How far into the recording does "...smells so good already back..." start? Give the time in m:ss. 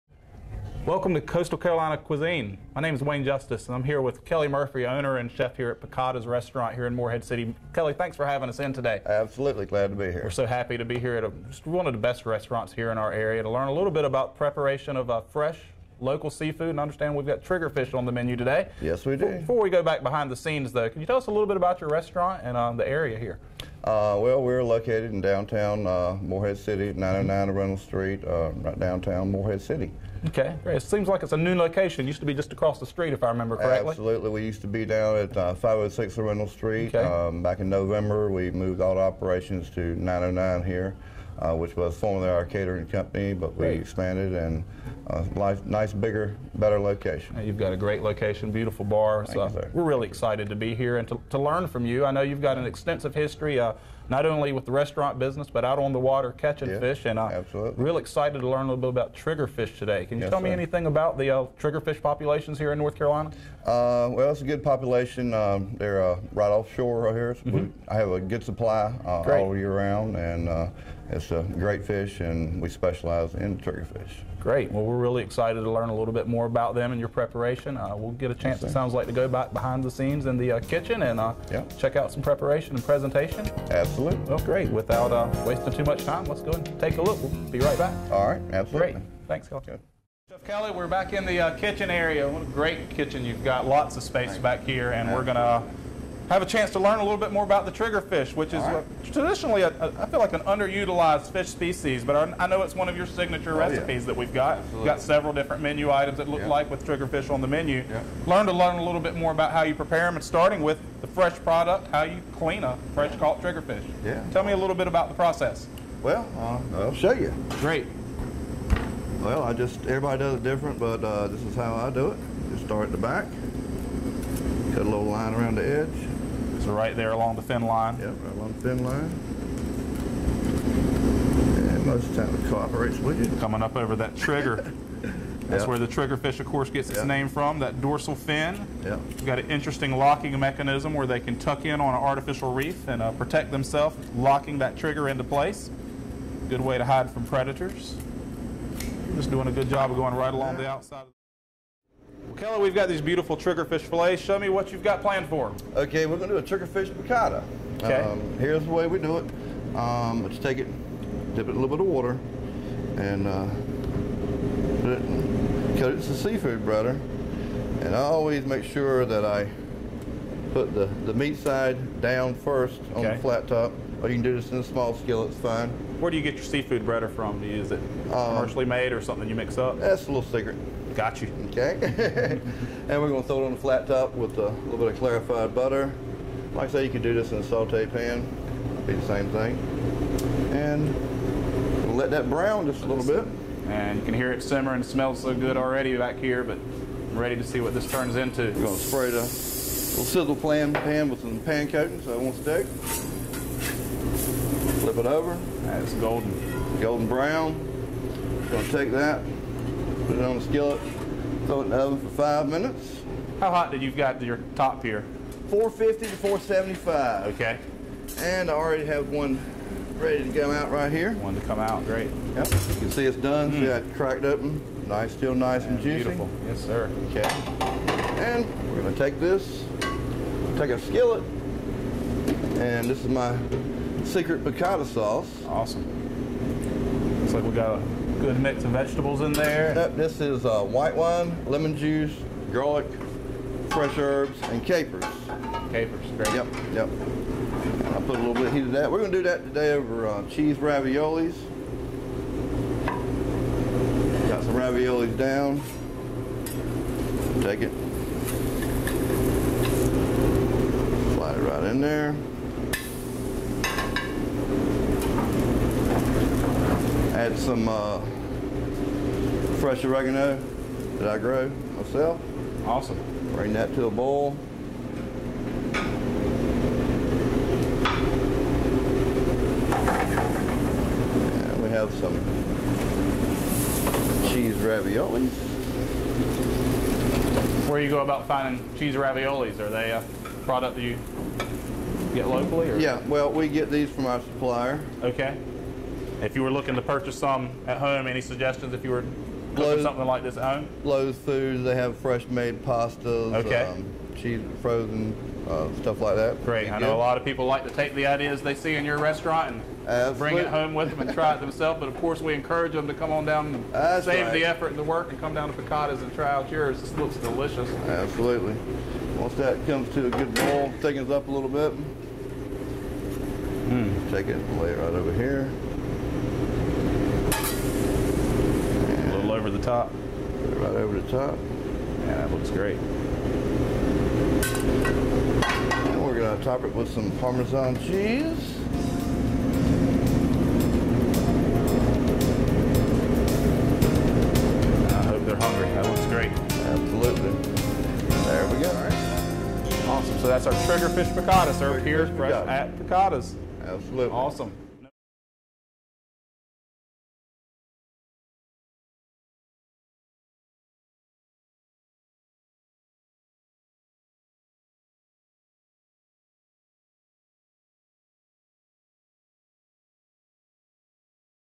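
3:14.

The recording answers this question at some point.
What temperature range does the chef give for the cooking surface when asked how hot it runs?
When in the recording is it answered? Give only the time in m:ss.
3:35.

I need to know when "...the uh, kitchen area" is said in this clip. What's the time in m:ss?
1:31.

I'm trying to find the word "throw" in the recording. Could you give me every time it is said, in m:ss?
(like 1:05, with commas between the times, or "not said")
3:03, 3:31.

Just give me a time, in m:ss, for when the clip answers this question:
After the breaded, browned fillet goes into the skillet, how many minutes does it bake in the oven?
3:32.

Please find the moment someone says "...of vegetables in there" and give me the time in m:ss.
3:58.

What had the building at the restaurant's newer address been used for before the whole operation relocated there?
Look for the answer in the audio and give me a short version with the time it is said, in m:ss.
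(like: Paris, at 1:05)
Catering company, at 0:42.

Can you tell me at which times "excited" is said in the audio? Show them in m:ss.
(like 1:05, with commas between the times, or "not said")
0:50, 0:57, 1:15.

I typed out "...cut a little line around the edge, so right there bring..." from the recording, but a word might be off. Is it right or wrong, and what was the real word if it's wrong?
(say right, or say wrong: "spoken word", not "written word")
wrong: "along", not "bring".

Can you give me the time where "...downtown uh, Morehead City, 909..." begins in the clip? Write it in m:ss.
0:25.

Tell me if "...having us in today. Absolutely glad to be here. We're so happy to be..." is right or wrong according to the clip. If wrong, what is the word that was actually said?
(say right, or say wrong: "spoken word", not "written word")
right.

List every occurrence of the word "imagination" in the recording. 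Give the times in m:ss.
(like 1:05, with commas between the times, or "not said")
not said.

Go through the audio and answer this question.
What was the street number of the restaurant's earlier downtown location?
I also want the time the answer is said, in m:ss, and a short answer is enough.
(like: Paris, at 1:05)
506, at 0:35.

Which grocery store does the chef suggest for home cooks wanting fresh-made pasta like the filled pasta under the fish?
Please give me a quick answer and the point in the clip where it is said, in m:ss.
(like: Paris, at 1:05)
Lowe's Foods, at 5:00.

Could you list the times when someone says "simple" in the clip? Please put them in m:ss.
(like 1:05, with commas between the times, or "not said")
not said.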